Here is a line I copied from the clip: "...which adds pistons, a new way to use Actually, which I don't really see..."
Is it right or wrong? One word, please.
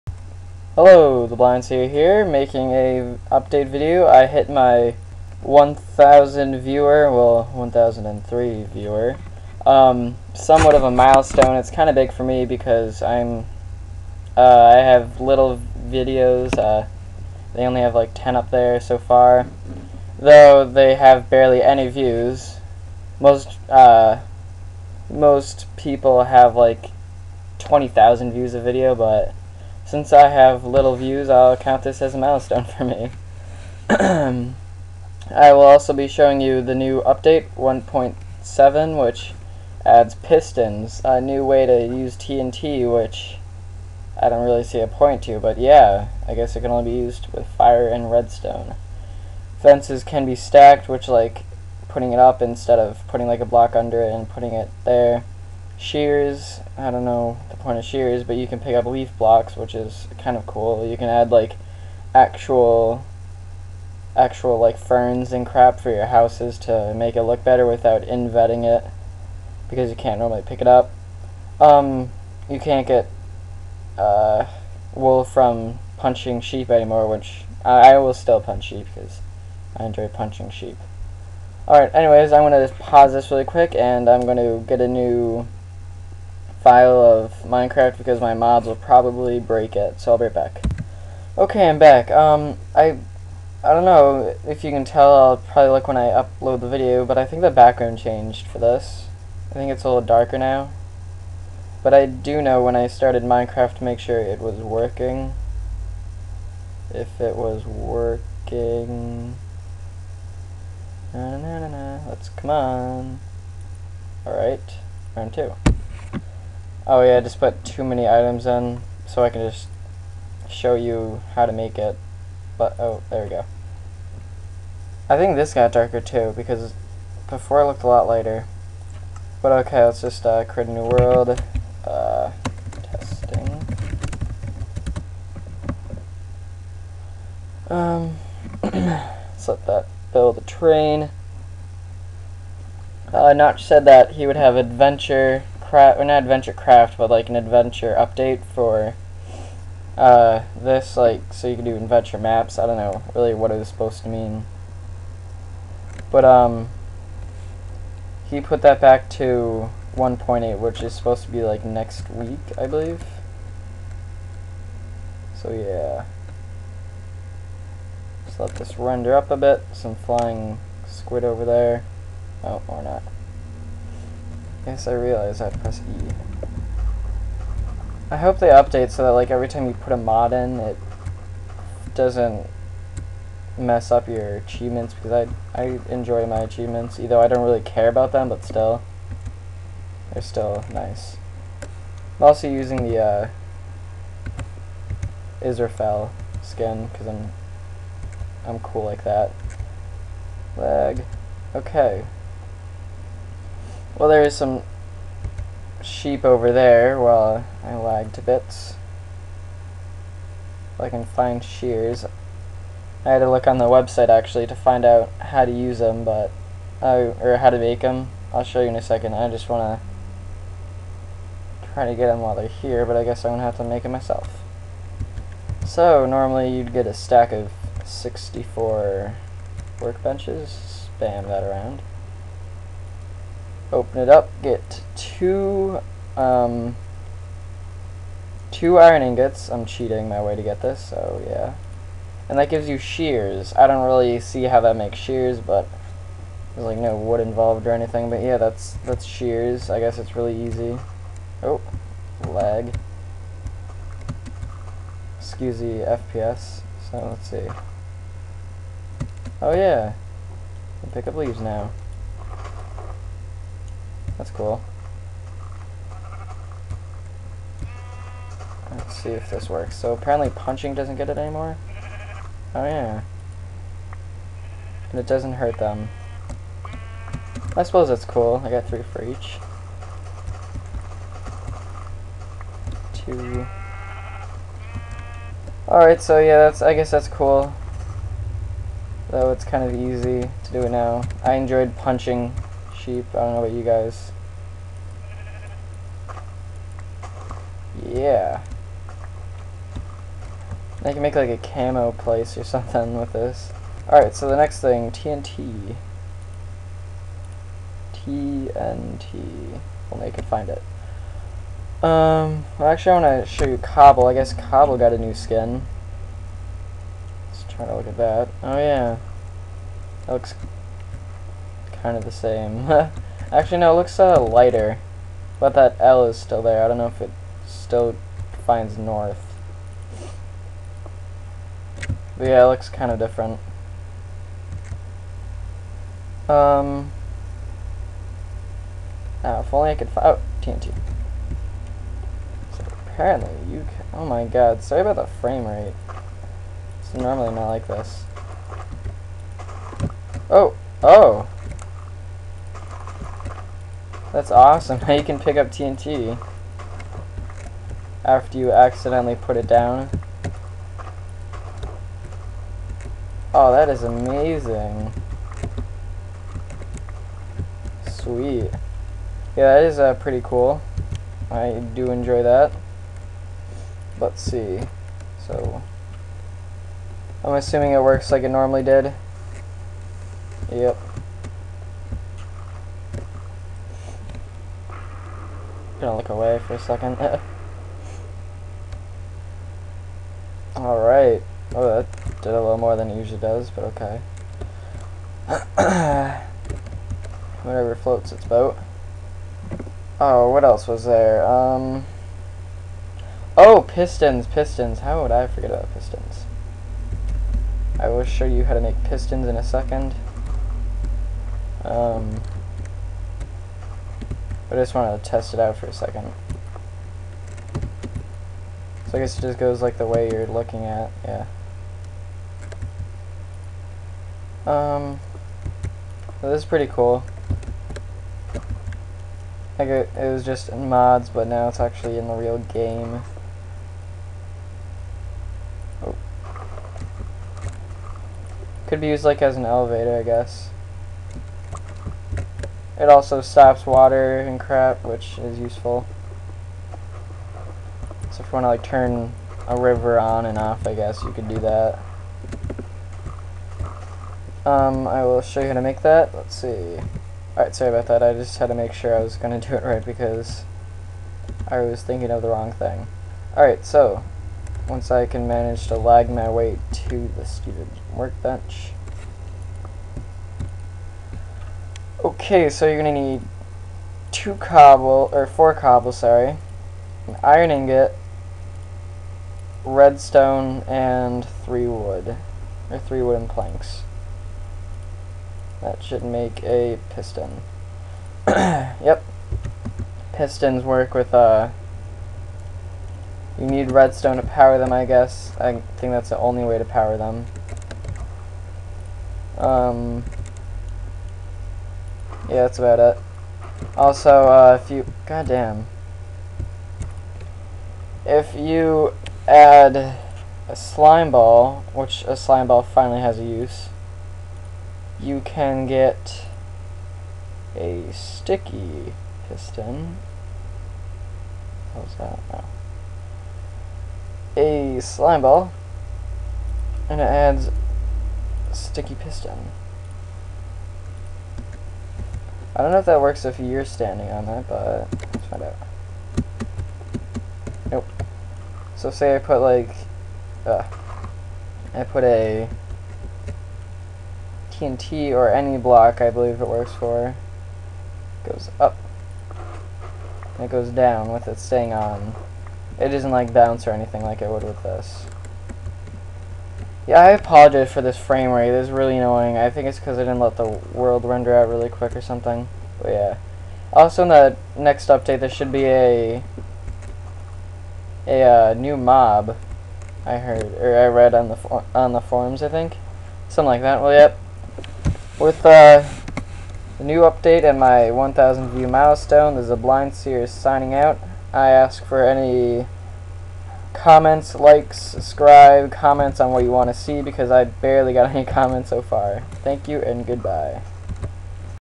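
wrong.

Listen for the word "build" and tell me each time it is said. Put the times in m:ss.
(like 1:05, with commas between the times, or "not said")
2:20.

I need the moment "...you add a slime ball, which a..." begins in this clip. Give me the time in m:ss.
8:28.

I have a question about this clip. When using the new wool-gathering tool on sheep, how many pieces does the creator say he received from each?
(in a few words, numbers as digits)
3.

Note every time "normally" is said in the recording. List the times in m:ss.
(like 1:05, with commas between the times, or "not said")
1:10, 3:46, 5:46, 6:18.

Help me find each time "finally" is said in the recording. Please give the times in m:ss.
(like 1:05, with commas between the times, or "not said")
8:32.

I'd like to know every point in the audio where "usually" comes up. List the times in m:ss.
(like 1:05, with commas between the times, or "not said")
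6:32.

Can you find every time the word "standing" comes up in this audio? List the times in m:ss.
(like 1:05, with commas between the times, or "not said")
8:53.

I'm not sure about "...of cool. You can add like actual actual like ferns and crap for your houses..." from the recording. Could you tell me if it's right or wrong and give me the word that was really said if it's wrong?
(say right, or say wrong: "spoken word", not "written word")
right.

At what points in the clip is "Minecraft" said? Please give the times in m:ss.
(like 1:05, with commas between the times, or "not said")
1:27, 1:43.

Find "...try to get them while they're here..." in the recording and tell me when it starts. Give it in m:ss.
3:41.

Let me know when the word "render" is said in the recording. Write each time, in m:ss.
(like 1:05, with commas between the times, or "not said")
2:48, 9:21.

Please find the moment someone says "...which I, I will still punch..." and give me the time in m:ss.
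1:17.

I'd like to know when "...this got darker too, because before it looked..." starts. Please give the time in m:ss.
2:05.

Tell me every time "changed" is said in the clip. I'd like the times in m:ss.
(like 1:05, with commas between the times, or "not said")
1:37.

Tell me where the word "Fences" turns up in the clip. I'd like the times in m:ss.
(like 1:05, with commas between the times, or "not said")
0:49.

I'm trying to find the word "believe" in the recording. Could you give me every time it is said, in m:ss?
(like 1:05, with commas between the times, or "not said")
2:42, 9:06.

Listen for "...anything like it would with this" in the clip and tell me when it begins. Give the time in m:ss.
9:13.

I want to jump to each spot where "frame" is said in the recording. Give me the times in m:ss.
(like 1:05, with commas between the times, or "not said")
5:45, 9:17.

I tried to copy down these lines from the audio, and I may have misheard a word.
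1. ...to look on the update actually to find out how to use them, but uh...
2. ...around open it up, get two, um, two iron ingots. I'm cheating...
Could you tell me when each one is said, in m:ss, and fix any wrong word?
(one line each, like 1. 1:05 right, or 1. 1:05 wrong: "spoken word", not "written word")
1. 3:33 wrong: "website", not "update"
2. 3:51 right.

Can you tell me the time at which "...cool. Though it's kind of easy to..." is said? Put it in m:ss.
4:47.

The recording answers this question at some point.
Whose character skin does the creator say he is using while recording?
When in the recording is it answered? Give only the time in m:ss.
3:15.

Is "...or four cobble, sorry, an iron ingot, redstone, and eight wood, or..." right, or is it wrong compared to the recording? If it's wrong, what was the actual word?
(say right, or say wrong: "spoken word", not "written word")
wrong: "three", not "eight".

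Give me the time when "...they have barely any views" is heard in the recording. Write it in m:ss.
0:20.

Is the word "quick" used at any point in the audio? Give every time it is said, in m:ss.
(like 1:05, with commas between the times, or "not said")
1:23, 9:21.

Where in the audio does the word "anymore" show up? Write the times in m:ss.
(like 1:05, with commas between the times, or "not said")
1:16, 4:31.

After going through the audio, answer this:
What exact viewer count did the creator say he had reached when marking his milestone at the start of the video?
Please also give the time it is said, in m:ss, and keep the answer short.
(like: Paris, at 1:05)
1,003, at 0:07.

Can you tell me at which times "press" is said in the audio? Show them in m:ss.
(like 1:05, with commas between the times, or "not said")
2:55.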